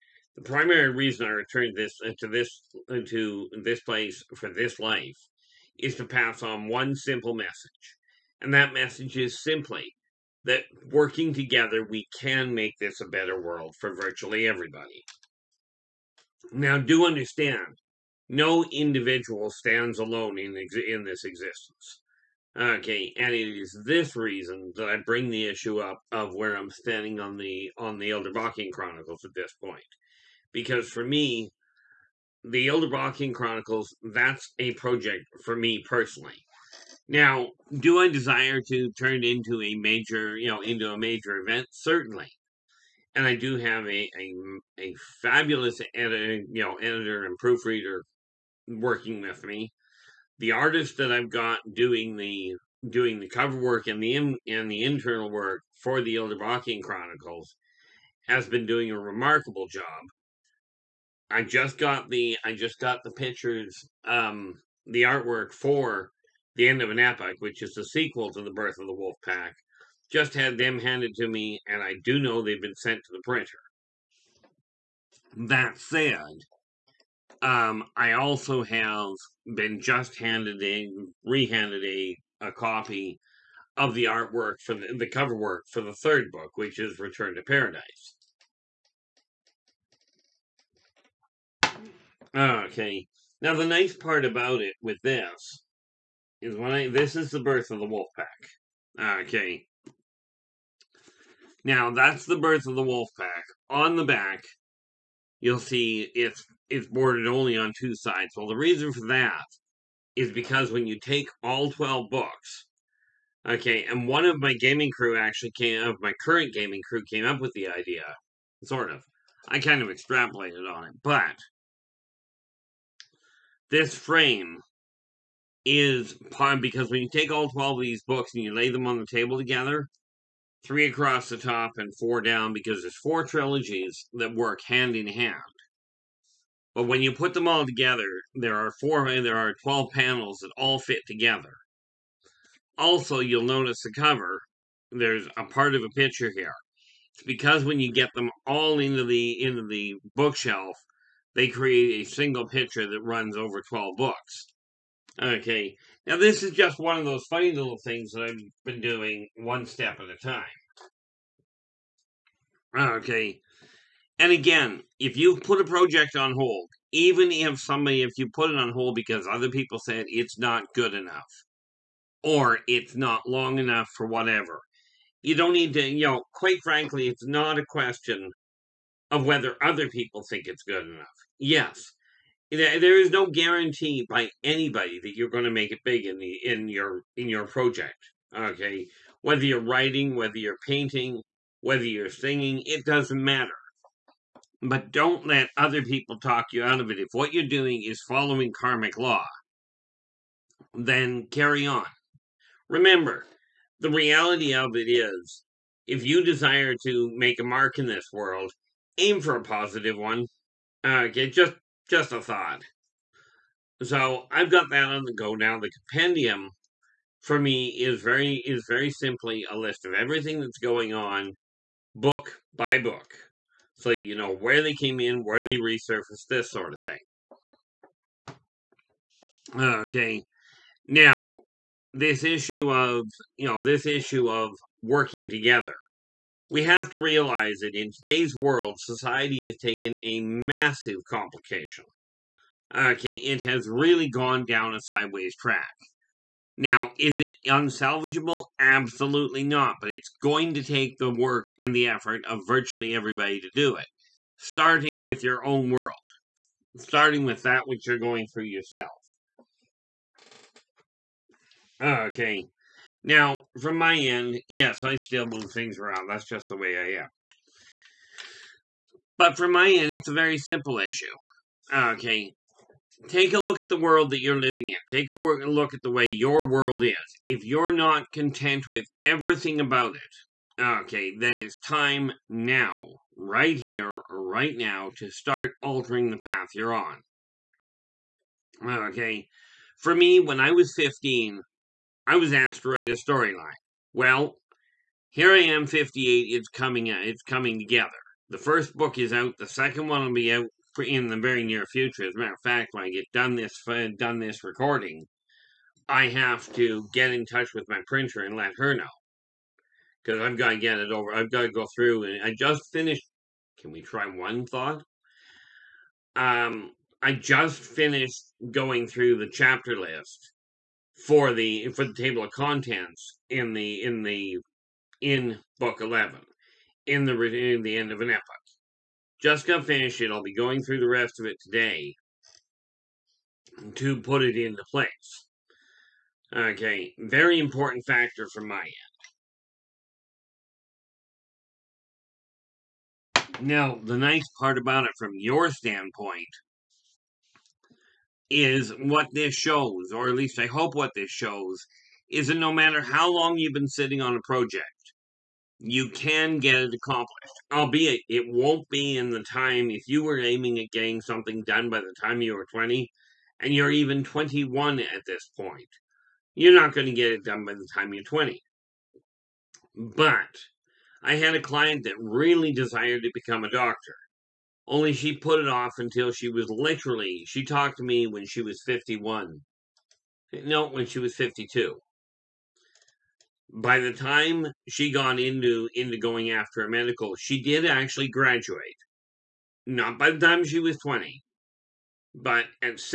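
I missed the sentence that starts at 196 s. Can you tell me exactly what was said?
If what you're doing is following karmic law, then carry on.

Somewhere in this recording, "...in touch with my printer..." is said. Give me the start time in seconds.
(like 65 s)
307 s.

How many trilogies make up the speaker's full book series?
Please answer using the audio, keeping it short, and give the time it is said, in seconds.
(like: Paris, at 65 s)
4, at 132 s.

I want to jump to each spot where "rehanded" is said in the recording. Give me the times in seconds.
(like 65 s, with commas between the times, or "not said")
81 s.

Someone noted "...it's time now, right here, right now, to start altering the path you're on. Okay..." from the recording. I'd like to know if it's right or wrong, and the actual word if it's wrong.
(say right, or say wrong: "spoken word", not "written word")
right.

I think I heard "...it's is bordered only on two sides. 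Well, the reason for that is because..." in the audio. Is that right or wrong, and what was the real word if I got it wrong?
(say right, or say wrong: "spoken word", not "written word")
right.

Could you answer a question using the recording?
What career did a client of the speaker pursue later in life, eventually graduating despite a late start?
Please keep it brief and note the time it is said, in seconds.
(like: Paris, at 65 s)
Doctor, at 373 s.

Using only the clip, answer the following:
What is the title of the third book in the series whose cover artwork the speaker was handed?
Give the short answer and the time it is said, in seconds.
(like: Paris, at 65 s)
Return to Paradise, at 86 s.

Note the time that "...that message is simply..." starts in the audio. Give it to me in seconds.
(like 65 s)
8 s.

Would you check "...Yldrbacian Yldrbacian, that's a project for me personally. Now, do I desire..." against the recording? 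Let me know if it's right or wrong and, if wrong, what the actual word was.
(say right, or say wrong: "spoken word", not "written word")
wrong: "Chronicles", not "Yldrbacian".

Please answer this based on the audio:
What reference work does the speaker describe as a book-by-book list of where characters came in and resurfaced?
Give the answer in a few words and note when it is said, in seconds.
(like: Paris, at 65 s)
The compendium, at 215 s.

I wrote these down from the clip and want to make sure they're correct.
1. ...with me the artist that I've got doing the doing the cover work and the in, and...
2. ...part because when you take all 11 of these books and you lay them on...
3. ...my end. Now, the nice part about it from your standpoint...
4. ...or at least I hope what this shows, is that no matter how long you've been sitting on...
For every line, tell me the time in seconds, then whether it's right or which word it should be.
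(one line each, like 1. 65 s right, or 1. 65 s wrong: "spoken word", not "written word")
1. 49 s right
2. 126 s wrong: "12", not "11"
3. 338 s right
4. 349 s right.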